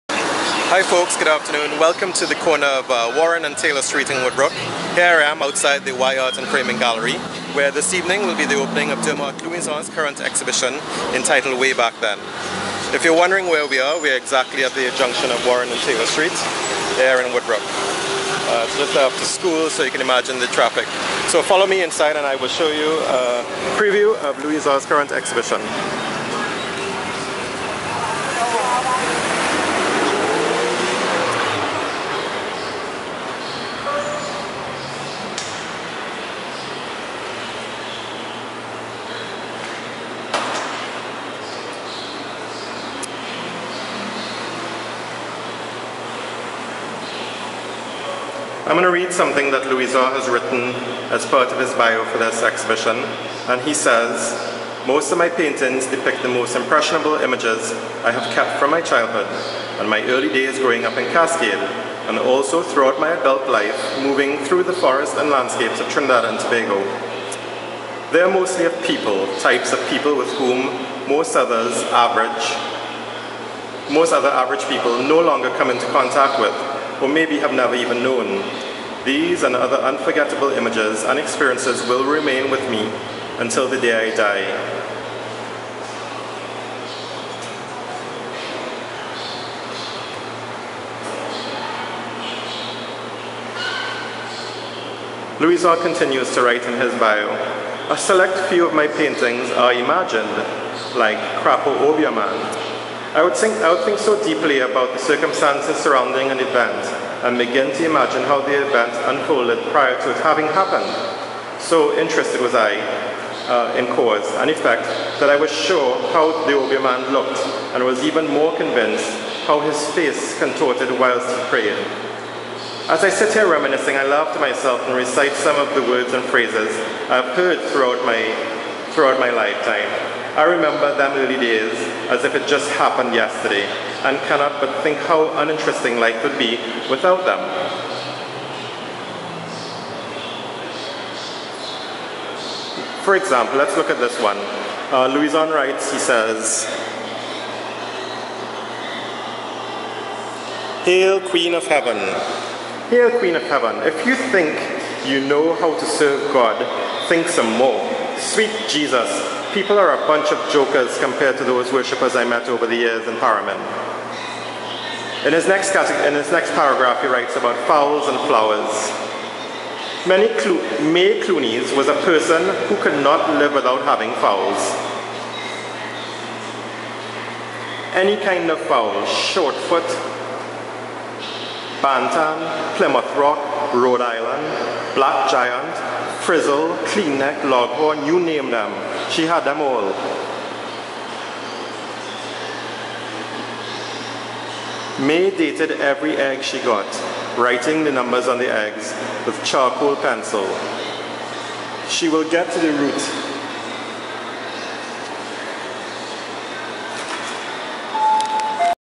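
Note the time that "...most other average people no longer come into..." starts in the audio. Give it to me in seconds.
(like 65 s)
73 s.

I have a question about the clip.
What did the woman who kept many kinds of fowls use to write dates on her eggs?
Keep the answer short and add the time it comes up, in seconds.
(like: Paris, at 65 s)
charcoal pencil, at 199 s.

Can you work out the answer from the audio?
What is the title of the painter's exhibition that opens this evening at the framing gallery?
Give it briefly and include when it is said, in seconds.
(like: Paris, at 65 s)
Way Back Then, at 11 s.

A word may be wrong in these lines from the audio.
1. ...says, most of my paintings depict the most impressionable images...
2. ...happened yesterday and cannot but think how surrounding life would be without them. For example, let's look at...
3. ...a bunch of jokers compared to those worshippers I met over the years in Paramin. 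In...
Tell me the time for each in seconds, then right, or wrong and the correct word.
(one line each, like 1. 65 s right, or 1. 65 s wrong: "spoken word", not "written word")
1. 53 s right
2. 132 s wrong: "uninteresting", not "surrounding"
3. 160 s right.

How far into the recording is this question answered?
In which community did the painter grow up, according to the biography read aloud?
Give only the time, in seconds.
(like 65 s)
61 s.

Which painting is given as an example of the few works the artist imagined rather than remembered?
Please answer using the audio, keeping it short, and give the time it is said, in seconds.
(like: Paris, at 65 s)
Crapo Obiaman, at 101 s.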